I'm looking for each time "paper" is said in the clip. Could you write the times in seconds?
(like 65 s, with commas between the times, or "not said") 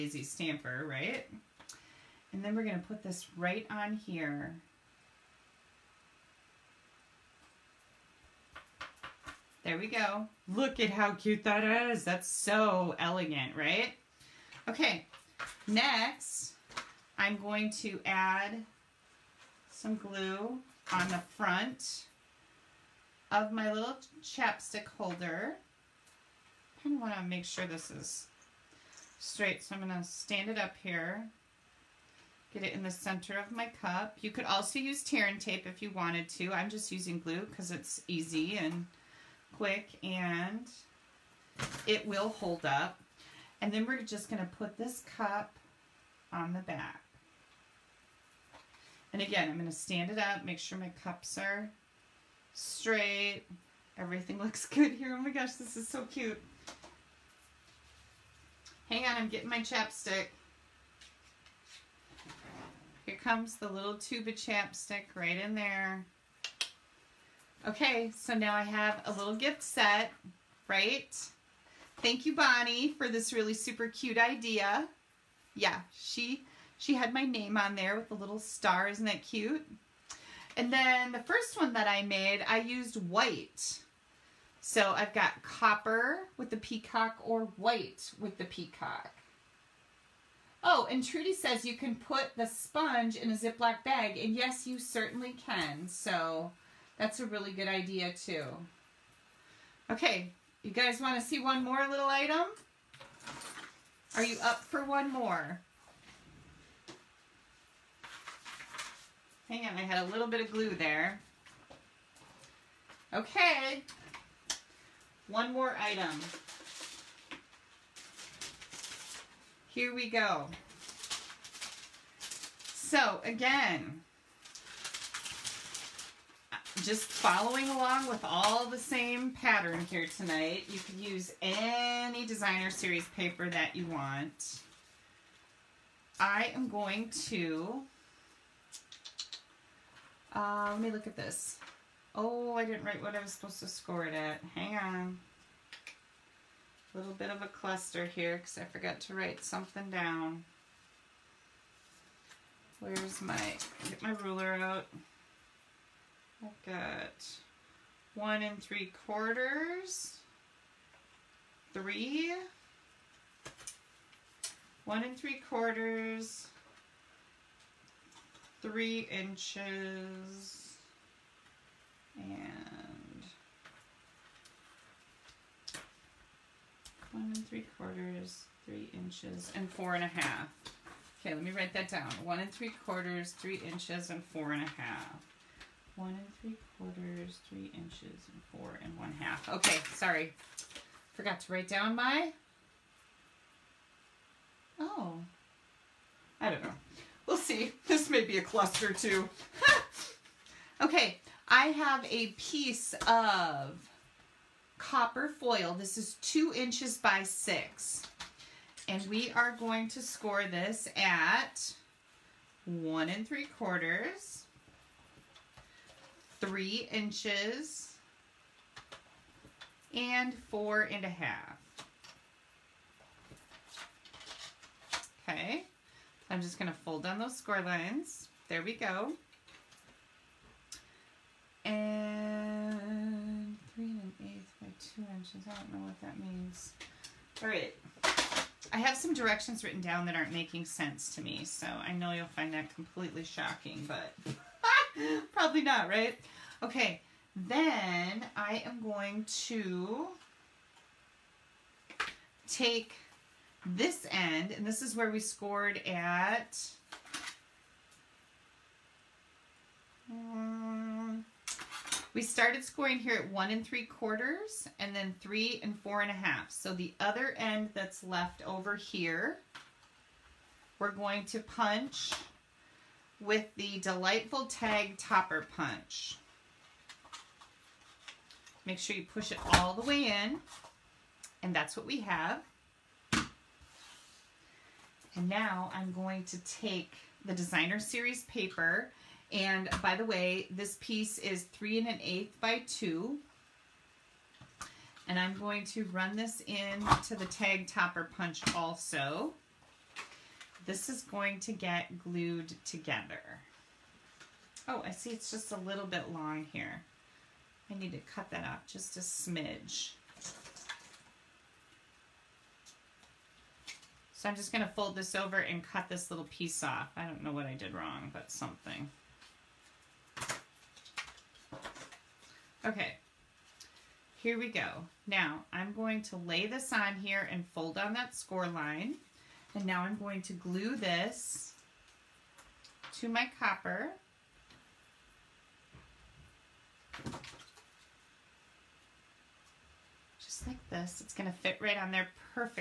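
133 s, 288 s.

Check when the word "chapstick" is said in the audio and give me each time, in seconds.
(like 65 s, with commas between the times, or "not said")
24 s, 59 s, 64 s.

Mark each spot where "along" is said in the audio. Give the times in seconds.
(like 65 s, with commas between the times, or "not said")
127 s.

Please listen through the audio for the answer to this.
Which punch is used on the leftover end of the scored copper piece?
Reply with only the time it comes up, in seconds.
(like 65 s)
273 s.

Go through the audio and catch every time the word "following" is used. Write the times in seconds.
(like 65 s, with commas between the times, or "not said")
127 s.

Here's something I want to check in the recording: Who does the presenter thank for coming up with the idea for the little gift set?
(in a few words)
Bonnie.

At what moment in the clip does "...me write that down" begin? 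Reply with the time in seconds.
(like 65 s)
181 s.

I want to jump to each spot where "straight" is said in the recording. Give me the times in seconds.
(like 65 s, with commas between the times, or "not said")
29 s, 52 s.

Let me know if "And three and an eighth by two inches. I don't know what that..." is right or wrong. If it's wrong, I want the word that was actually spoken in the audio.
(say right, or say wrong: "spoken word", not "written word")
right.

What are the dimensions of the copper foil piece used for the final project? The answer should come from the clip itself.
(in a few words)
2 inches by 6.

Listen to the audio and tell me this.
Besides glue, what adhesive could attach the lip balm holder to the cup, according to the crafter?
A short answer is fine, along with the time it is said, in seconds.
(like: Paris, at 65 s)
tear and tape, at 35 s.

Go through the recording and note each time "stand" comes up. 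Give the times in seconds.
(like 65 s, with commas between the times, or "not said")
30 s, 49 s.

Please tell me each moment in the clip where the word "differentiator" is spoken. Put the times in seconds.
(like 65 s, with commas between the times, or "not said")
not said.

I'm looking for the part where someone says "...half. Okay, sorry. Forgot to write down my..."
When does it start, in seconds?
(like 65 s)
189 s.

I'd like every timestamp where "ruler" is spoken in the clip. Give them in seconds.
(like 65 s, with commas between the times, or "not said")
154 s.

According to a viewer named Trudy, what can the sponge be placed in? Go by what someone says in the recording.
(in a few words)
Ziploc bag.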